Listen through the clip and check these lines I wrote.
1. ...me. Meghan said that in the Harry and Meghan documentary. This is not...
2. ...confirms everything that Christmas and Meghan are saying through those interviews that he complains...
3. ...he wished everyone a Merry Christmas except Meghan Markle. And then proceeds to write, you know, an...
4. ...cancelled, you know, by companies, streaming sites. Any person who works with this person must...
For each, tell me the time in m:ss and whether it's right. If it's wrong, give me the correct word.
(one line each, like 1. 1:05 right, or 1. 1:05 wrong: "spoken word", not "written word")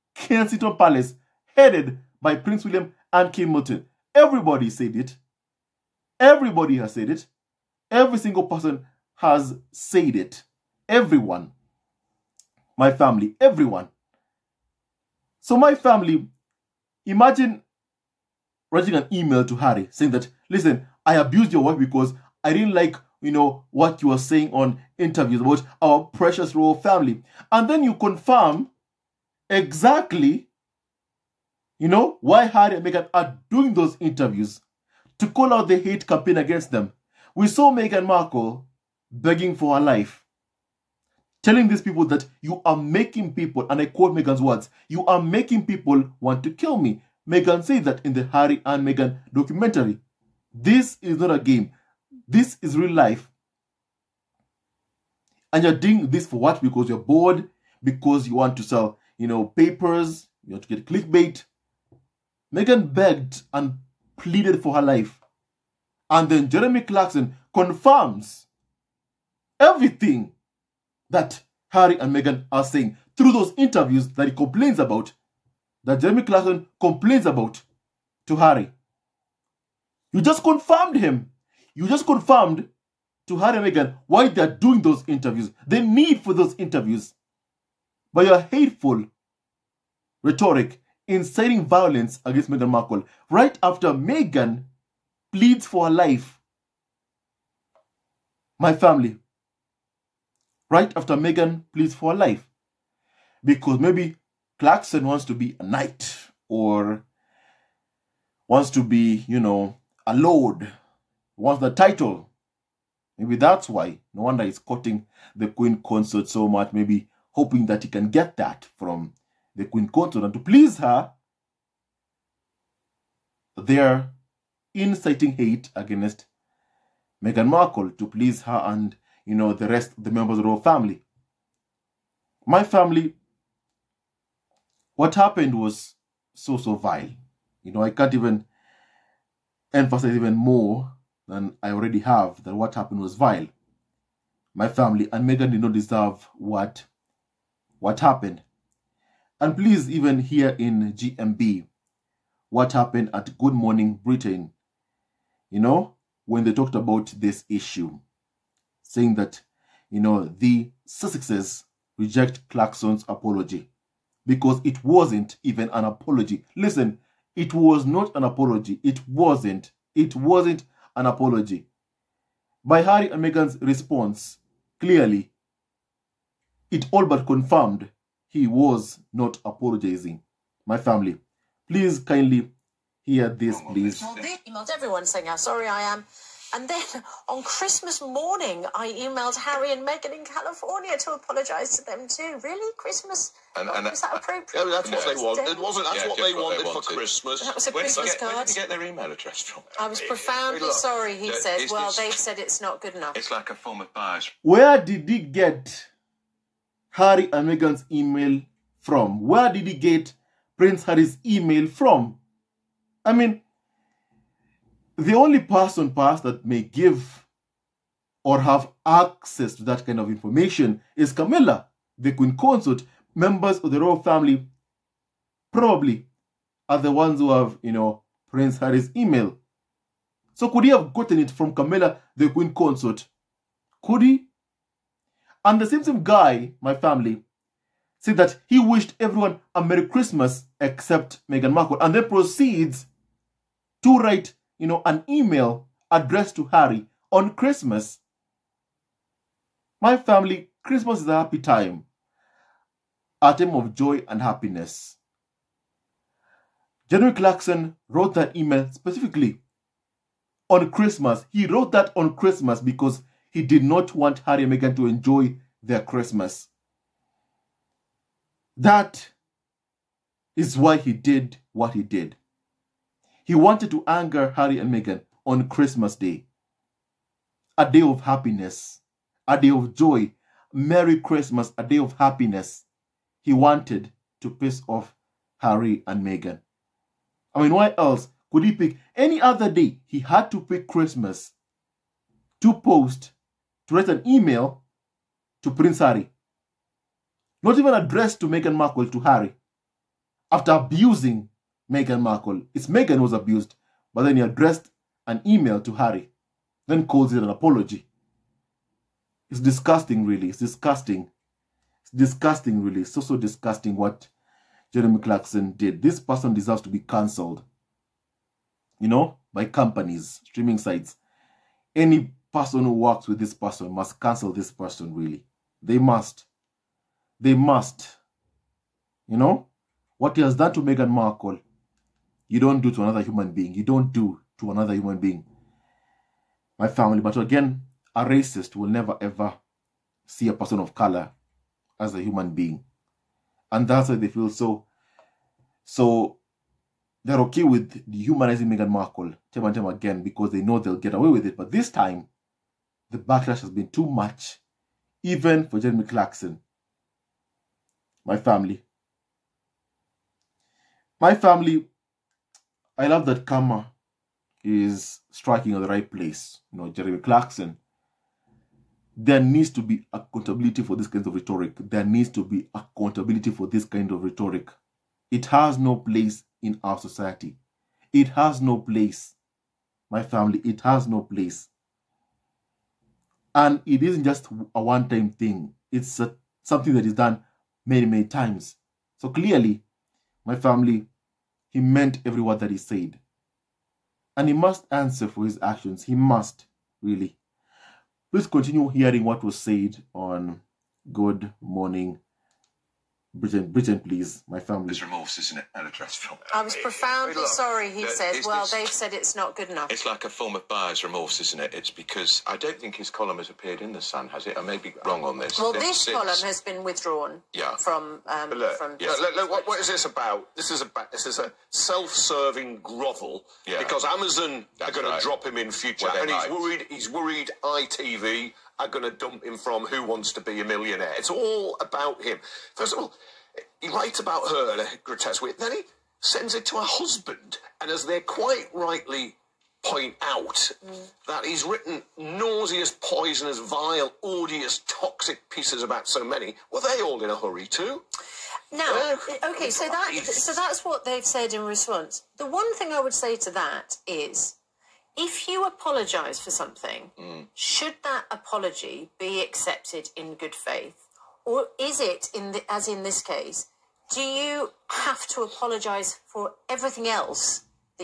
1. 0:46 right
2. 1:07 wrong: "Harry", not "Christmas"
3. 3:58 right
4. 5:16 right.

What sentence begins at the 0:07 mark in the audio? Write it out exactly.
Every single person has said it.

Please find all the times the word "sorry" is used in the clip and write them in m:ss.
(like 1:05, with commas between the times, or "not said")
3:05, 3:20, 6:47.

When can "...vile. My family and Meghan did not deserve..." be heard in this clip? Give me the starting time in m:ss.
2:23.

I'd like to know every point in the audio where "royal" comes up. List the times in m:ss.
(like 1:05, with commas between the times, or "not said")
0:26, 2:10, 3:43.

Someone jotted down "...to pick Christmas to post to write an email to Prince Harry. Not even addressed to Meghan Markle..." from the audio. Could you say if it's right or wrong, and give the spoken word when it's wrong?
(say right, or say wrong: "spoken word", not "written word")
right.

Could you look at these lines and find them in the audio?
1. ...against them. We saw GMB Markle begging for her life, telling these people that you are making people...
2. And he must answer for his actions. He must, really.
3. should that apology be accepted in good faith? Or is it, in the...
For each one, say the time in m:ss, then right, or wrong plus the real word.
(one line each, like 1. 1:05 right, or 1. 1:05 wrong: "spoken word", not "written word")
1. 0:36 wrong: "Meghan", not "GMB"
2. 6:34 right
3. 7:37 right.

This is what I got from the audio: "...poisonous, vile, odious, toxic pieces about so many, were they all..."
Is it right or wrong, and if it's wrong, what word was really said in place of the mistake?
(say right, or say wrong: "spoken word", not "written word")
right.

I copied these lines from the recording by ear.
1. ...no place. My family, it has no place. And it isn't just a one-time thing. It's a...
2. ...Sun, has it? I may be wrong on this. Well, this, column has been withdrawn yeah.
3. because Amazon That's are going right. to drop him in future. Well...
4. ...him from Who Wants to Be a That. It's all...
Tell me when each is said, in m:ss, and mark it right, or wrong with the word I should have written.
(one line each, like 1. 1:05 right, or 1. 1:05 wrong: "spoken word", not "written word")
1. 6:18 right
2. 6:53 right
3. 7:03 right
4. 7:09 wrong: "Millionaire", not "That".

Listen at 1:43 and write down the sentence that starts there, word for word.
Because maybe Clarkson wants to be a knight or wants to be, you know, a lord, wants the title.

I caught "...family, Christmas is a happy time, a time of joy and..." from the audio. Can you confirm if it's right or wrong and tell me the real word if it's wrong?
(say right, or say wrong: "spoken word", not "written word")
right.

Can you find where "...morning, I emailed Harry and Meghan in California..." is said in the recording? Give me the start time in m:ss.
3:08.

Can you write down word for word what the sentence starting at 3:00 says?
My family, please kindly hear this, please.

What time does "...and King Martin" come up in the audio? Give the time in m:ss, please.
0:03.